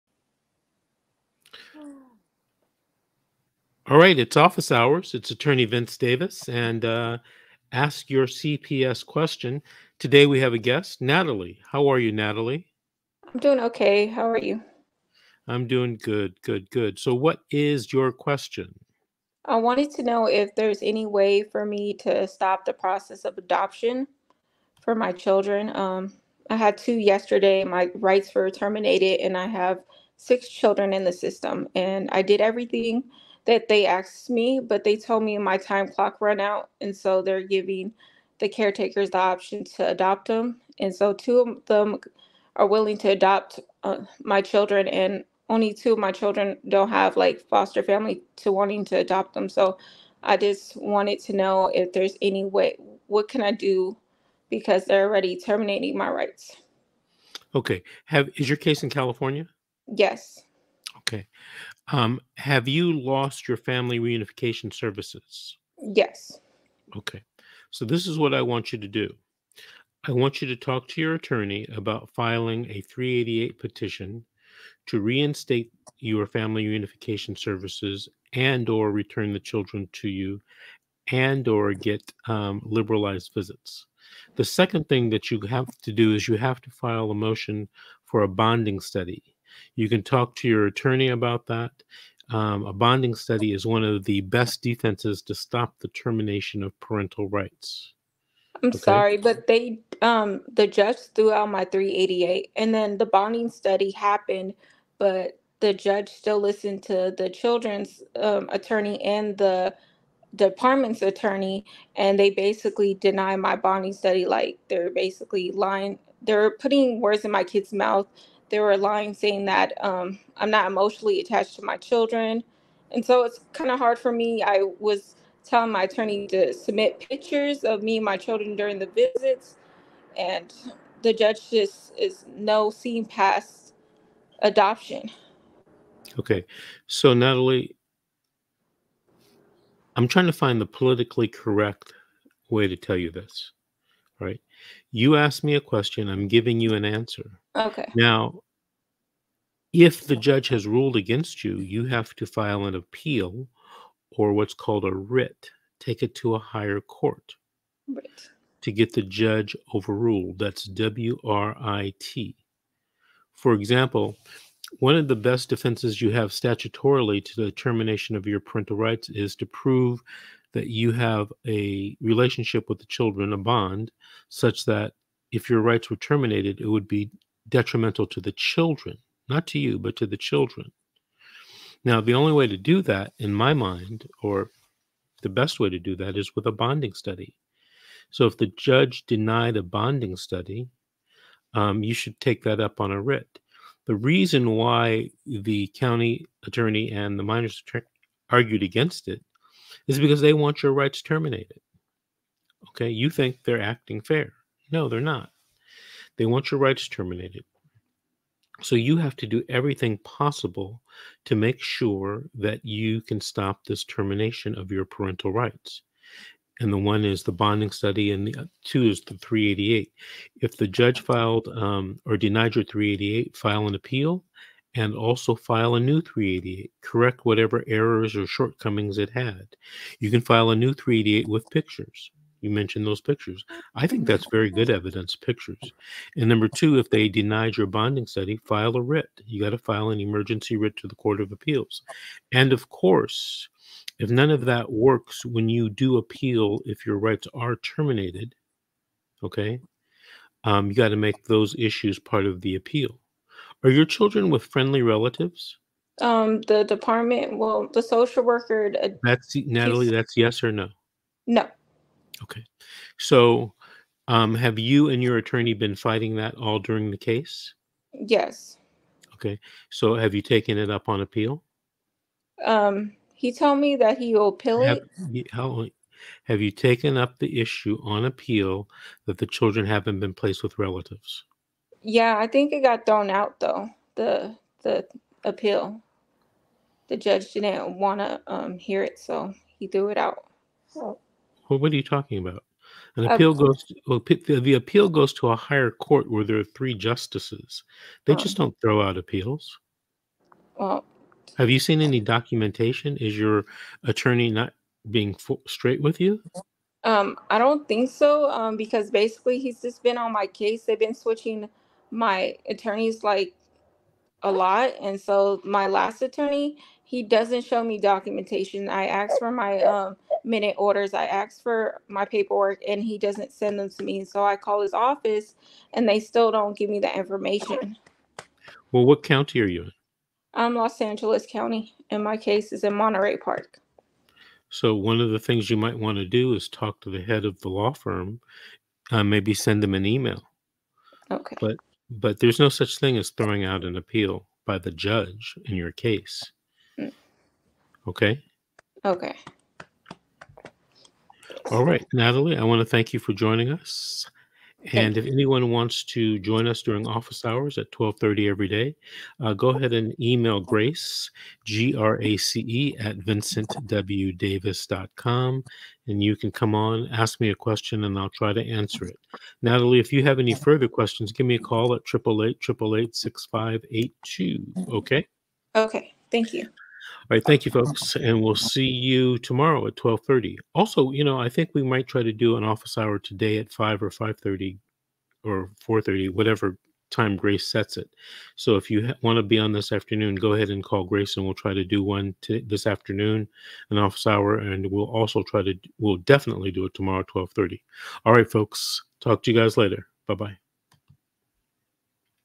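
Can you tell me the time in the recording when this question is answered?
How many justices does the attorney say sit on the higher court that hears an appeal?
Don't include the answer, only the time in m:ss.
4:56.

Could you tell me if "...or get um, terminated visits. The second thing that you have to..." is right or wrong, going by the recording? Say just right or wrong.
wrong.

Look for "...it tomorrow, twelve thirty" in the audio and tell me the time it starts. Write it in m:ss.
6:36.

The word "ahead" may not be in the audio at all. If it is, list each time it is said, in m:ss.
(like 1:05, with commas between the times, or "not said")
5:59, 6:30.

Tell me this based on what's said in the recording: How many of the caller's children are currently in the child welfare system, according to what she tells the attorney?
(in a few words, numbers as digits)
6.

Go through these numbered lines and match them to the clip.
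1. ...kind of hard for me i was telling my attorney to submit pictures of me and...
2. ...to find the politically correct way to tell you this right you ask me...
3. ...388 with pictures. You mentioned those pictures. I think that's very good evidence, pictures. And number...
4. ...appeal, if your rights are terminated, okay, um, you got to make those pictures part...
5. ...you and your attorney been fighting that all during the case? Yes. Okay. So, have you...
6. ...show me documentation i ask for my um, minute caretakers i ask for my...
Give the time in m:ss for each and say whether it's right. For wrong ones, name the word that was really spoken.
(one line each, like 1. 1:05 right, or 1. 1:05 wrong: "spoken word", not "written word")
1. 2:03 right
2. 2:20 right
3. 3:50 right
4. 4:05 wrong: "issues", not "pictures"
5. 4:24 right
6. 5:17 wrong: "orders", not "caretakers".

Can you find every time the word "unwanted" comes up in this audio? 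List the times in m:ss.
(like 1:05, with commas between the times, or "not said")
not said.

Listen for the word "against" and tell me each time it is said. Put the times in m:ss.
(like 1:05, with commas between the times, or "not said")
2:30, 3:18.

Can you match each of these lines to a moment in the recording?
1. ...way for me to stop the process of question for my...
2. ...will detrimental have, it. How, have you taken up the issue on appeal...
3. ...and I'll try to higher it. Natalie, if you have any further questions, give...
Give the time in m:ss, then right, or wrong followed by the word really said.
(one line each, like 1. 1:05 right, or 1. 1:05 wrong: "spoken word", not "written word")
1. 0:21 wrong: "adoption", not "question"
2. 4:34 wrong: "appeal", not "detrimental"
3. 6:07 wrong: "answer", not "higher".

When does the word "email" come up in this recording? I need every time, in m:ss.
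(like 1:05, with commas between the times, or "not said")
5:39, 5:59.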